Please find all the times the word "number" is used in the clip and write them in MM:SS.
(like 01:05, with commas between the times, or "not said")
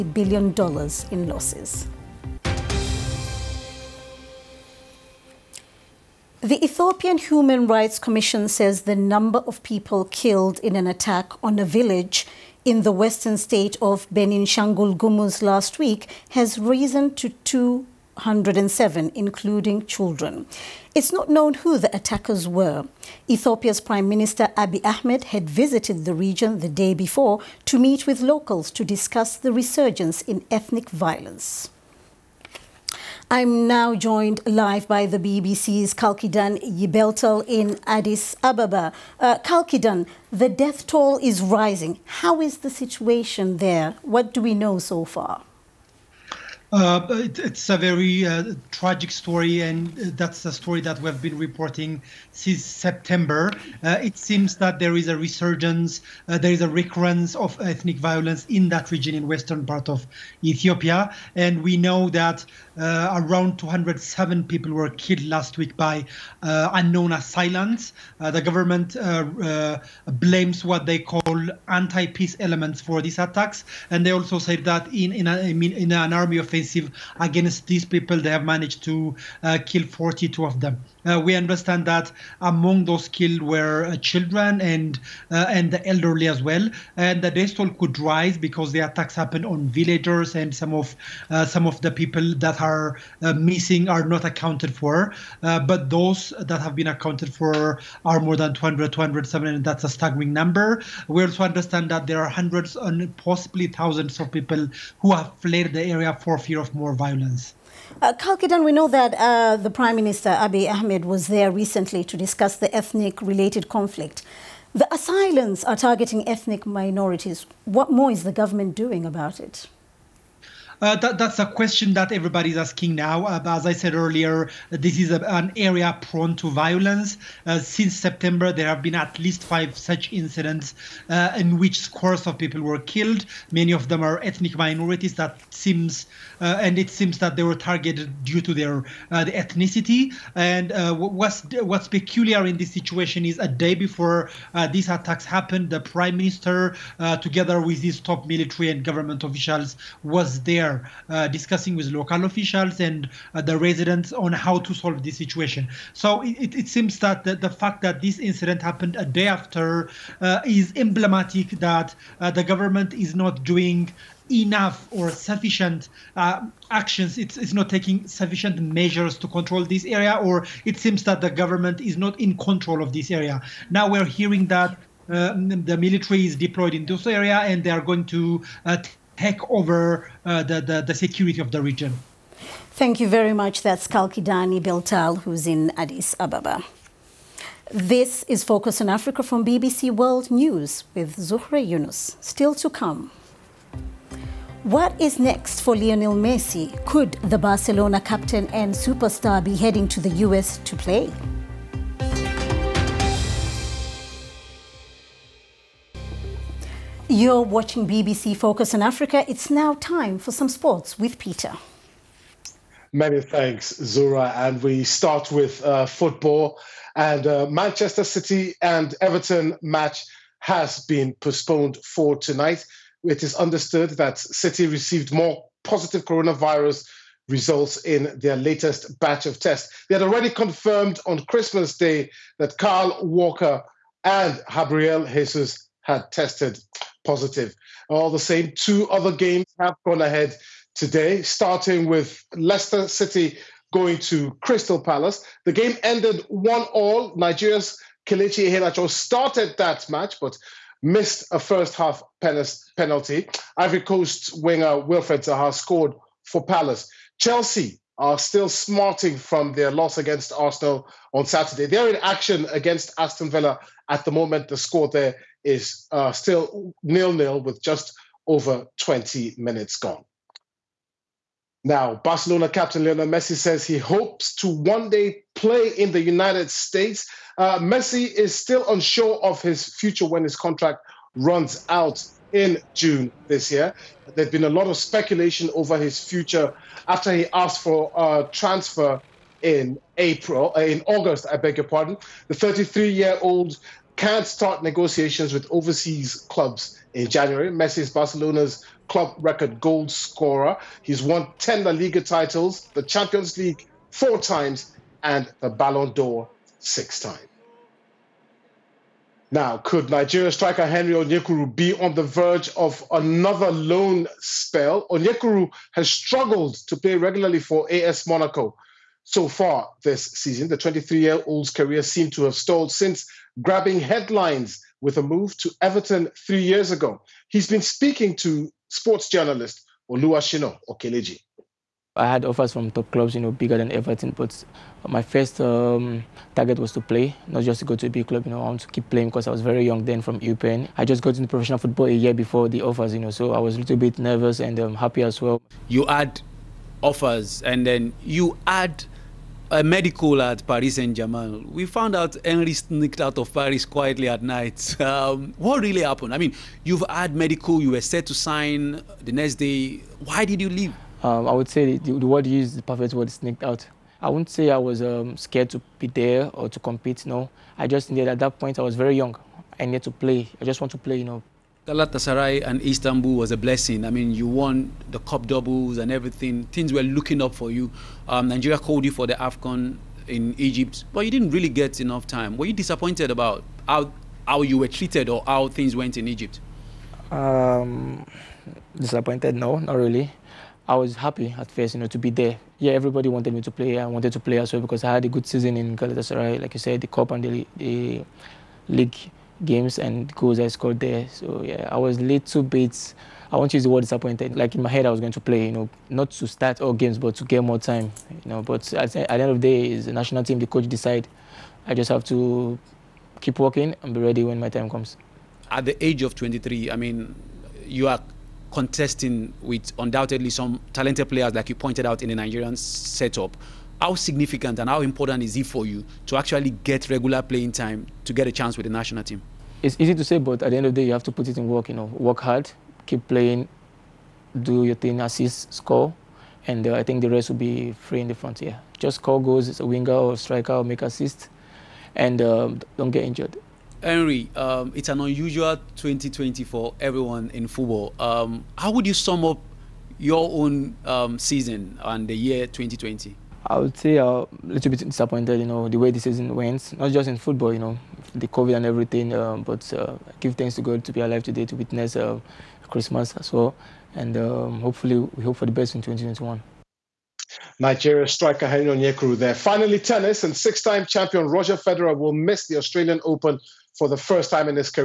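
00:08, 01:40.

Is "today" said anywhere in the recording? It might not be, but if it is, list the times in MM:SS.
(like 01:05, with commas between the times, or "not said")
04:00, 07:41.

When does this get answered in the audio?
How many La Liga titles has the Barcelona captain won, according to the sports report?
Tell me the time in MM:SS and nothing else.
05:01.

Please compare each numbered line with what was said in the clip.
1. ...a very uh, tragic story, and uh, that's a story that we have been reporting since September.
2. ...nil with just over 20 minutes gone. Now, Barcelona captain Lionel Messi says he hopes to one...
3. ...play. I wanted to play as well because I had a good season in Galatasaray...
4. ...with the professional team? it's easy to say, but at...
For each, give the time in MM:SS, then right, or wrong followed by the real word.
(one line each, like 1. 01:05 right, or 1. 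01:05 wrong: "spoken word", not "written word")
1. 00:47 right
2. 04:27 right
3. 06:33 right
4. 07:08 wrong: "national", not "professional".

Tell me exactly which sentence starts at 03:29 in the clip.
It's now time for some sports with Peter.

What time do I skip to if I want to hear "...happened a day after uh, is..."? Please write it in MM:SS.
02:38.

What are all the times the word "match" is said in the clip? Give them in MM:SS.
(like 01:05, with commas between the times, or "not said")
03:39, 04:09.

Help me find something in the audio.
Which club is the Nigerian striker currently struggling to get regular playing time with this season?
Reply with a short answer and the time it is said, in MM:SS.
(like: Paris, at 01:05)
AS Monaco, at 05:17.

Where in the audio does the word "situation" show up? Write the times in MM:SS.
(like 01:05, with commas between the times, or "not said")
00:42, 02:22, 02:35.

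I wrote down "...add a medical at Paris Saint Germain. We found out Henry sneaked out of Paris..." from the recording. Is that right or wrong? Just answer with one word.
right.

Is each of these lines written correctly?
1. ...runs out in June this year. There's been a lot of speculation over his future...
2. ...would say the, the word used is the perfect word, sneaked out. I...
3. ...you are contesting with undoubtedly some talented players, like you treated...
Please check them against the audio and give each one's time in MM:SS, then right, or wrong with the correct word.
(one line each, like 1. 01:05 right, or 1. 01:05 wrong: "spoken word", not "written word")
1. 04:41 right
2. 06:01 right
3. 06:57 wrong: "pointed", not "treated".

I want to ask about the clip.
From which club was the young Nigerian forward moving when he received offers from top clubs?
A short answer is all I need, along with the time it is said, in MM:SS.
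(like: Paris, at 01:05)
Eupen, at 05:40.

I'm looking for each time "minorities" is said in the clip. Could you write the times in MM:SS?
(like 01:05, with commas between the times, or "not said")
01:56, 02:14.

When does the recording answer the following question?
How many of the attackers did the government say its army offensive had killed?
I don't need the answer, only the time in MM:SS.
01:19.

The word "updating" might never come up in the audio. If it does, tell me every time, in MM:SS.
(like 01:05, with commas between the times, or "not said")
not said.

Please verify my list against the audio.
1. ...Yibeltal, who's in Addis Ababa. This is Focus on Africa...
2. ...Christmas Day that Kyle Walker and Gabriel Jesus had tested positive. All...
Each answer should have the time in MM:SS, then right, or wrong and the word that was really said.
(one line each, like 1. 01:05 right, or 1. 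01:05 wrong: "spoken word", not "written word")
1. 03:04 right
2. 03:51 right.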